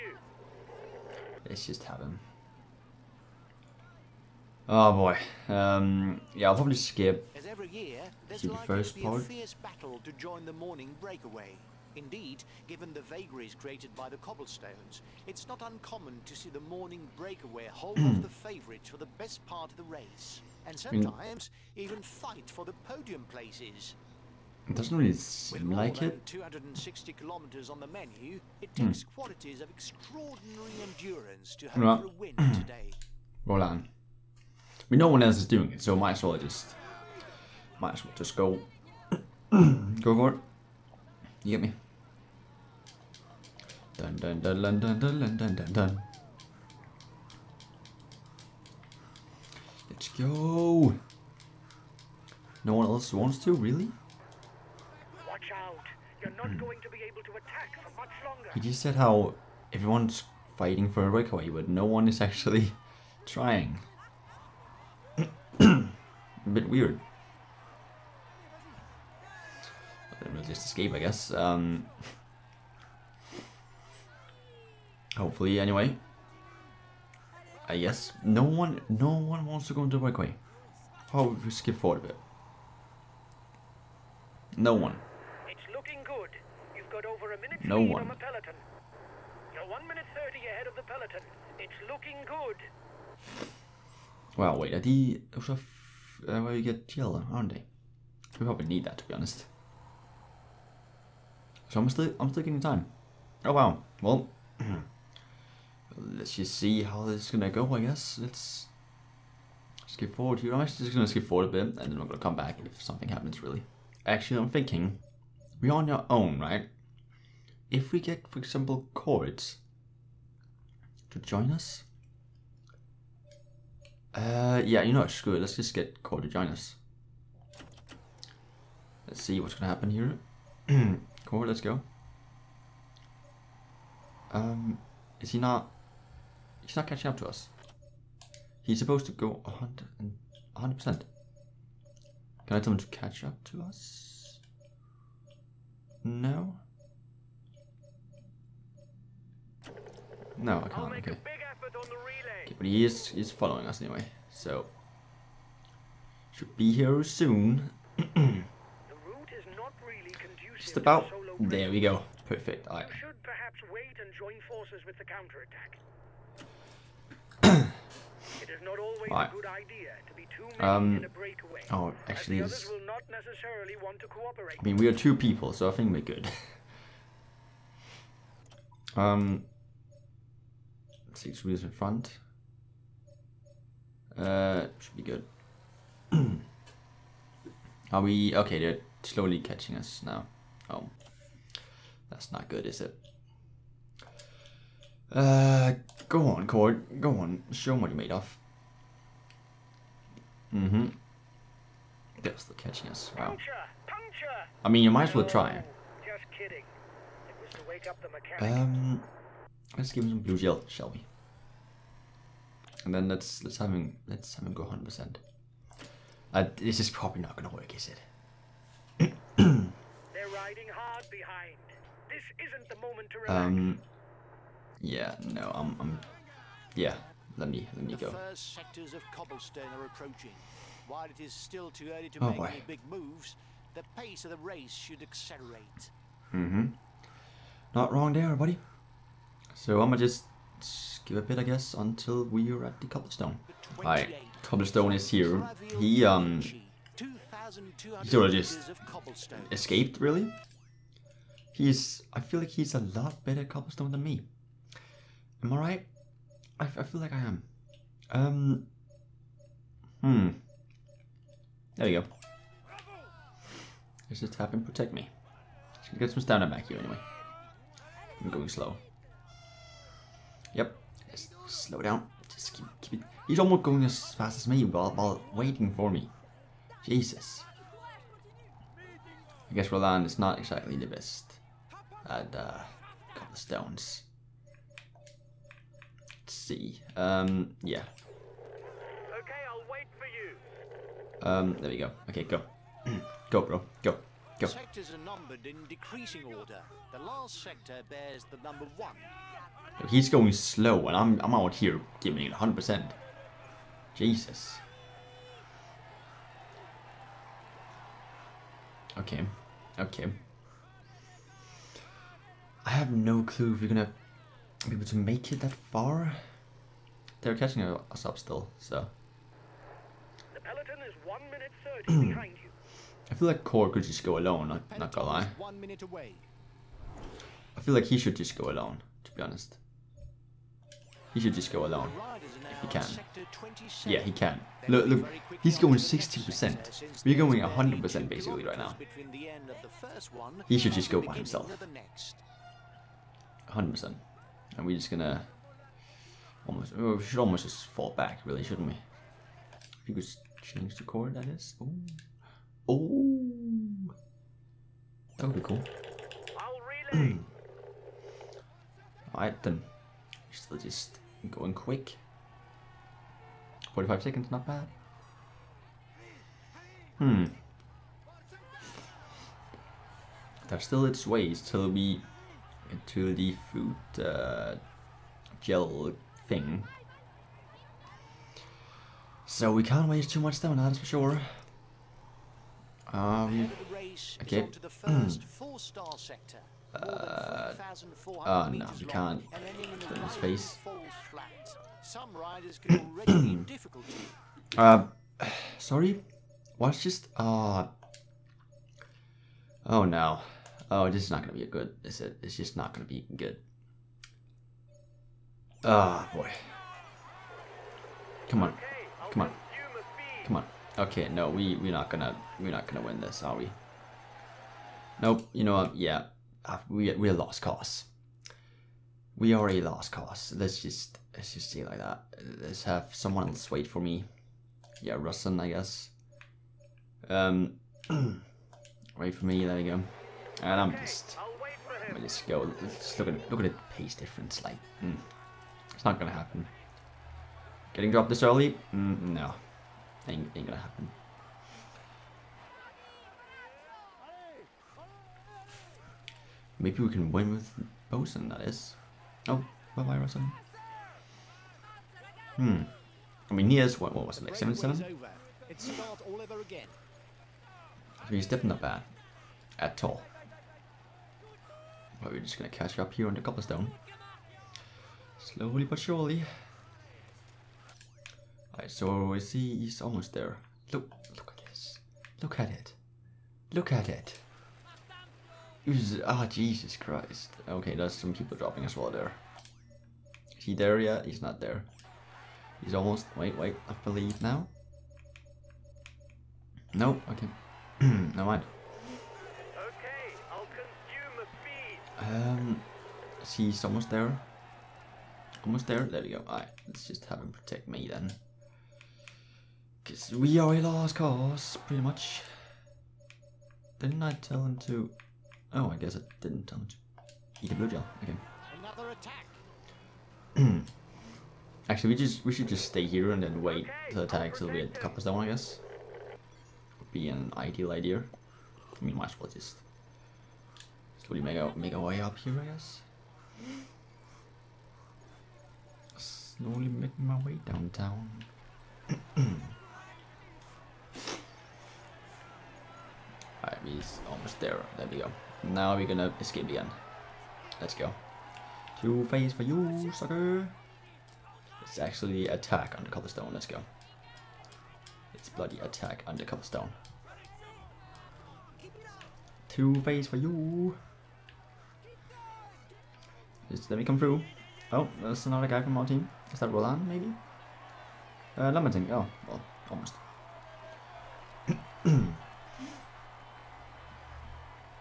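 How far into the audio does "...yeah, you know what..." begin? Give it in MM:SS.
02:04.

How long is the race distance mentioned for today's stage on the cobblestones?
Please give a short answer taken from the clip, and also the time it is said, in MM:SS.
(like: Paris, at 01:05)
260 kilometers, at 00:26.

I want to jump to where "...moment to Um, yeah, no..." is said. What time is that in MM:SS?
03:42.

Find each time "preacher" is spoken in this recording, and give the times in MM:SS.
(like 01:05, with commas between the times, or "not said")
not said.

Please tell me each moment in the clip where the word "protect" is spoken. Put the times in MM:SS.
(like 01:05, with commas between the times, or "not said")
04:24, 08:17.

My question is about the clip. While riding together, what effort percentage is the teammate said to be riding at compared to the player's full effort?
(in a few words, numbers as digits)
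60%.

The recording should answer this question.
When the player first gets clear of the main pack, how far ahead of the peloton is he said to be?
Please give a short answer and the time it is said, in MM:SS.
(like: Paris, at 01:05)
1 minute 30, at 01:29.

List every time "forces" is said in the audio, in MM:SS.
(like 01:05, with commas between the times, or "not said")
02:44.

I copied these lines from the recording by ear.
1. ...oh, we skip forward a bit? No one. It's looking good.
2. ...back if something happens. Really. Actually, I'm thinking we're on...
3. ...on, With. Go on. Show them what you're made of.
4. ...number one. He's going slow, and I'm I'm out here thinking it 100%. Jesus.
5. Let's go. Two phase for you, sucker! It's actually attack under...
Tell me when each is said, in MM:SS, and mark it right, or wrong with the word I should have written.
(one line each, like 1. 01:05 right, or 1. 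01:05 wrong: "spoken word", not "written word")
1. 01:21 right
2. 01:52 right
3. 03:16 wrong: "Cord", not "With"
4. 04:58 wrong: "giving", not "thinking"
5. 08:57 right.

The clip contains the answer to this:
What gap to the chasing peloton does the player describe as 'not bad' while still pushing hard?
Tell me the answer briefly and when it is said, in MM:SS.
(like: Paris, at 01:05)
45 seconds, at 06:03.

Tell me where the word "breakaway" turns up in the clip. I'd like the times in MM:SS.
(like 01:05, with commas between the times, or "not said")
00:17, 01:01, 02:51.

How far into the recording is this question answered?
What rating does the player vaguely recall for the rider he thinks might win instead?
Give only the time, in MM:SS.
07:34.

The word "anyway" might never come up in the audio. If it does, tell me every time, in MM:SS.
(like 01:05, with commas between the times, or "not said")
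01:15, 02:33, 04:26.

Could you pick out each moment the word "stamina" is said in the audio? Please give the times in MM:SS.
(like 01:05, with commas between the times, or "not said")
04:26, 06:20.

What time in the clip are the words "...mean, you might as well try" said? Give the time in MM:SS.
03:24.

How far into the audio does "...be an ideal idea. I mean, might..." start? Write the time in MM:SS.
08:36.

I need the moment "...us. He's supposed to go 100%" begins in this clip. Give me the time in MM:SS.
02:17.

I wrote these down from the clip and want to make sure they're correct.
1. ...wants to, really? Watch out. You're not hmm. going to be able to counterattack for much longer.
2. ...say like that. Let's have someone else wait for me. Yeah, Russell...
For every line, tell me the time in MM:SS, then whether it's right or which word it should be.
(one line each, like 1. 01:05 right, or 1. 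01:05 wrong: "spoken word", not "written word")
1. 00:53 wrong: "attack", not "counterattack"
2. 07:01 right.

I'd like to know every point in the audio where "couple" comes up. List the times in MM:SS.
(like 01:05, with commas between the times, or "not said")
04:43, 08:34.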